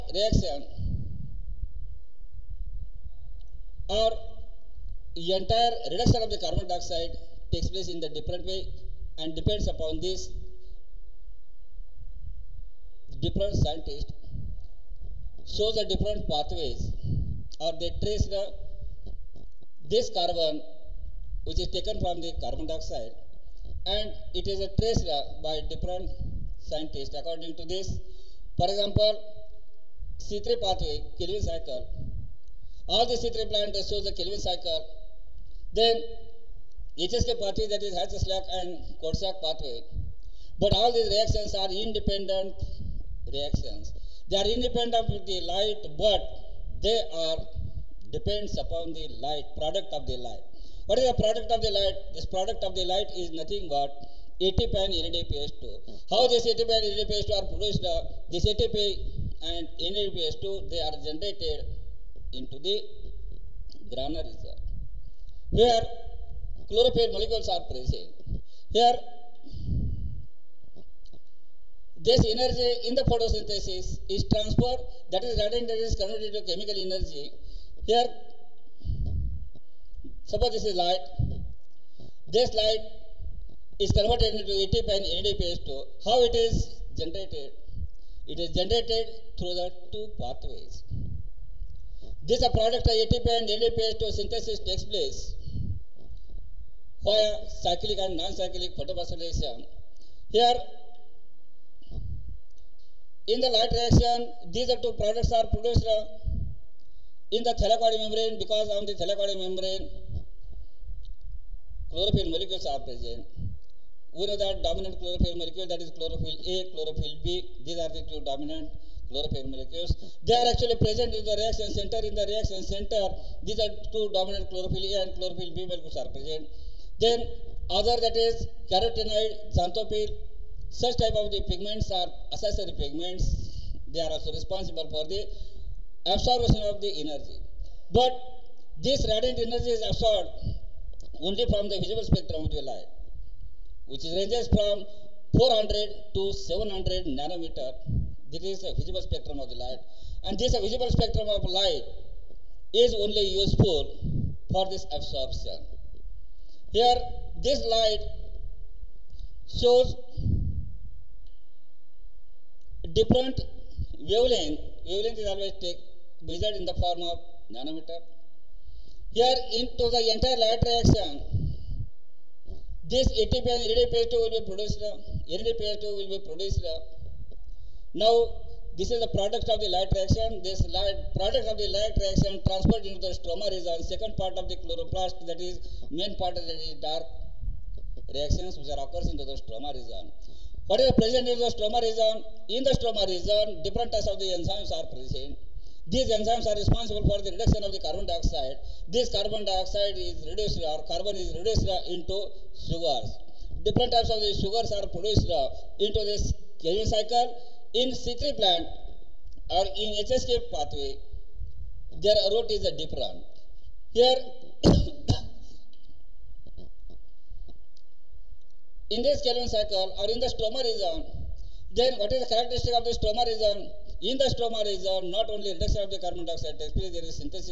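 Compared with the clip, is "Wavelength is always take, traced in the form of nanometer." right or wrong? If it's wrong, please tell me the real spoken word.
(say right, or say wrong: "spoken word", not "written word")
wrong: "measured", not "traced".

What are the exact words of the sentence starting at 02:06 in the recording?
Then other that is carotenoid, xanthophyll, such type of the pigments are accessory pigments.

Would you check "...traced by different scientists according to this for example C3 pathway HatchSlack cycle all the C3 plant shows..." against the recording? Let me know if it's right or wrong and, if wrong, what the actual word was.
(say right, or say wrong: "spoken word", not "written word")
wrong: "Calvin", not "HatchSlack".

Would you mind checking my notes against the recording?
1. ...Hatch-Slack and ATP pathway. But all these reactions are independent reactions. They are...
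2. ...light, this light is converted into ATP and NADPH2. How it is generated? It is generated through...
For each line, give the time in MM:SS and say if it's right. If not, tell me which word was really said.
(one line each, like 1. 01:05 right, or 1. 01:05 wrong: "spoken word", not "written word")
1. 00:37 wrong: "Kortschak", not "ATP"
2. 01:20 right.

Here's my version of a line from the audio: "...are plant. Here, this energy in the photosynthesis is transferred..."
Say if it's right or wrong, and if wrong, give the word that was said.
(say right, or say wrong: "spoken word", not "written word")
wrong: "present", not "plant".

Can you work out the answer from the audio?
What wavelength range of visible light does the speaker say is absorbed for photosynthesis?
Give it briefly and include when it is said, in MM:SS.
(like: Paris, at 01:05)
400 to 700 nanometers, at 02:25.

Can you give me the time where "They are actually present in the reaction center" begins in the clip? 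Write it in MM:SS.
02:00.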